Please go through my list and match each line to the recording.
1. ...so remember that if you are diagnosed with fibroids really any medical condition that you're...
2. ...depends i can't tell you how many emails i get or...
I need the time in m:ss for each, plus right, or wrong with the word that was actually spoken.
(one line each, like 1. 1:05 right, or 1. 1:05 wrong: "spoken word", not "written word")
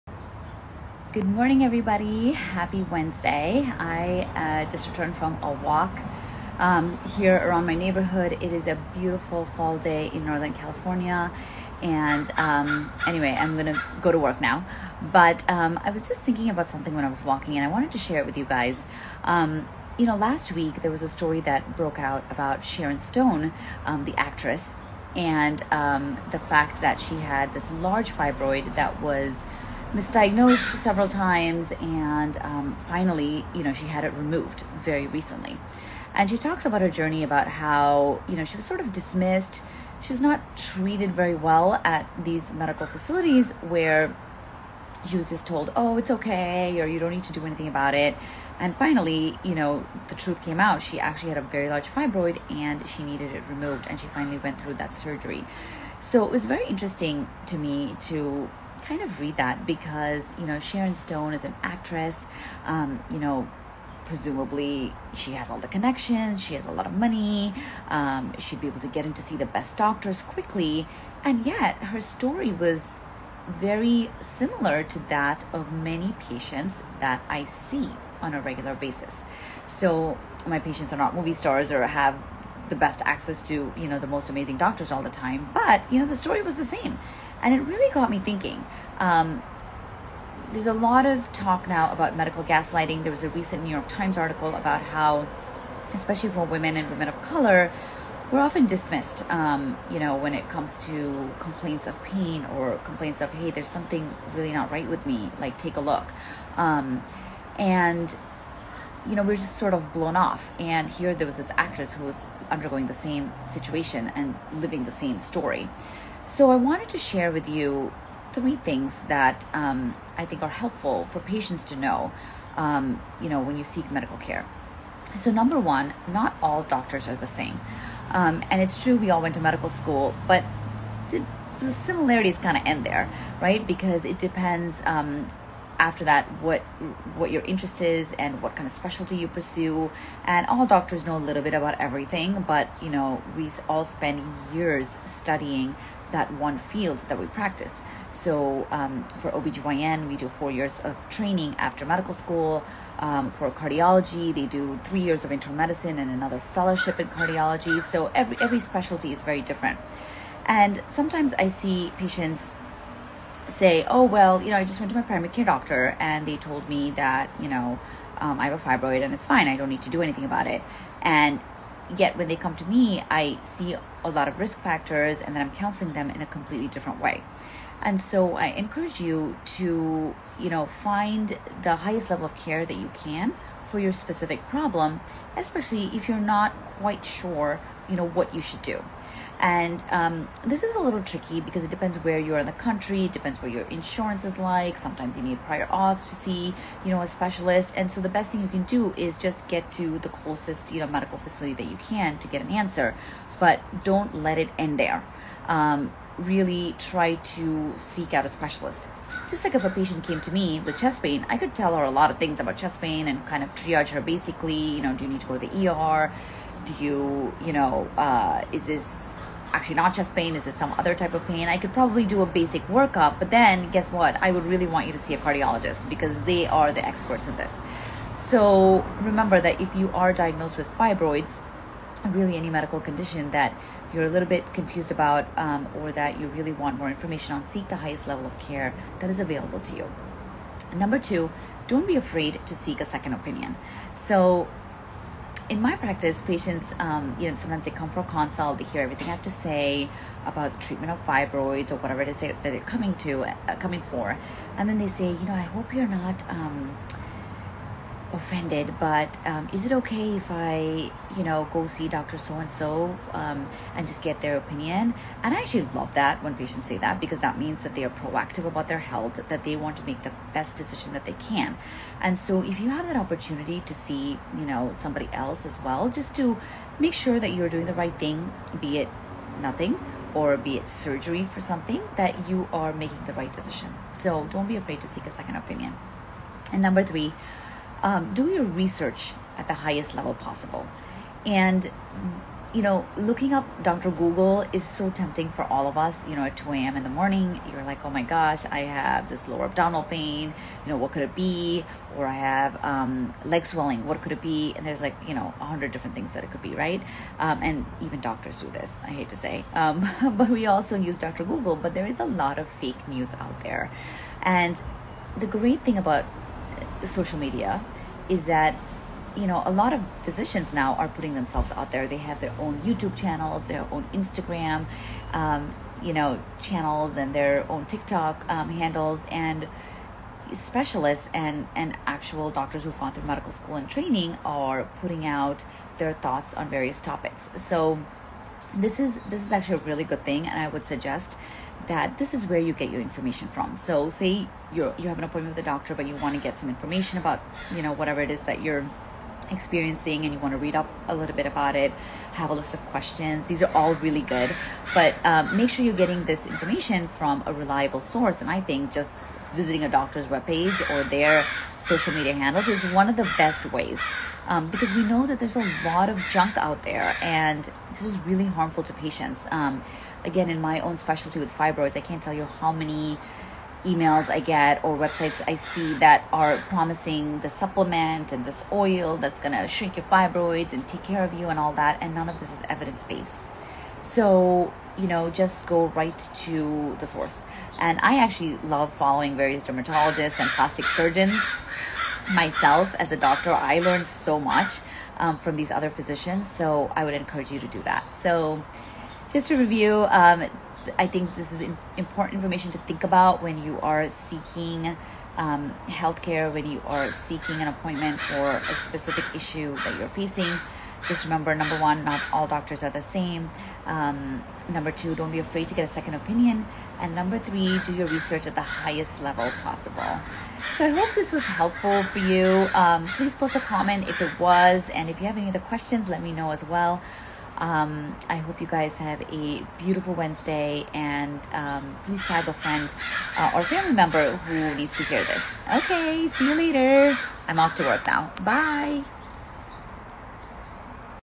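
1. 3:48 right
2. 6:11 wrong: "fibroids", not "depends".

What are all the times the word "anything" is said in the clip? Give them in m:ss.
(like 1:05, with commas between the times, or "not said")
0:47, 2:50.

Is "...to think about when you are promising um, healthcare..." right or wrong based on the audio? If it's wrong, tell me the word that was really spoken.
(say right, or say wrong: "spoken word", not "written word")
wrong: "seeking", not "promising".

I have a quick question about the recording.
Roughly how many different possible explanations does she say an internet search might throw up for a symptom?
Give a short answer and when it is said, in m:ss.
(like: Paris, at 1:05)
100, at 5:05.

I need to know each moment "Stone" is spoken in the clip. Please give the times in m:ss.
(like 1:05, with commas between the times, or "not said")
0:23, 1:00.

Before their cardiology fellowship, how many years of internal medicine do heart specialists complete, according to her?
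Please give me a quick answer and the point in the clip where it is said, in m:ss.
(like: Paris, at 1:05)
3 years, at 2:34.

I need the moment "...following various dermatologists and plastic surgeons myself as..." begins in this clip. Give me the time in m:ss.
6:28.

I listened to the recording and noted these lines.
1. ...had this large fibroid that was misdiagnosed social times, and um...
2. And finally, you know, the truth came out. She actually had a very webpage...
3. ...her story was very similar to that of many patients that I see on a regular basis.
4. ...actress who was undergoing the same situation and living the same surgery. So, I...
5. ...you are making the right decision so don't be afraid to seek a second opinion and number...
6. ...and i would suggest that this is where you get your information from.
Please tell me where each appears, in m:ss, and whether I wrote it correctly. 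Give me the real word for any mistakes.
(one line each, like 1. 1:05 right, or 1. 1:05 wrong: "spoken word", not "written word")
1. 0:27 wrong: "several", not "social"
2. 0:48 wrong: "large", not "webpage"
3. 1:11 right
4. 1:51 wrong: "story", not "surgery"
5. 4:42 right
6. 5:40 right.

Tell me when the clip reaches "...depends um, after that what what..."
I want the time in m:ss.
2:14.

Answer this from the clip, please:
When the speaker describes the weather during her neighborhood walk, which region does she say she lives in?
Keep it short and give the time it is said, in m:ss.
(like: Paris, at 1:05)
Northern California, at 0:10.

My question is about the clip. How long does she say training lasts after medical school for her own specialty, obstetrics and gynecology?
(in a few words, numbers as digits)
4 years.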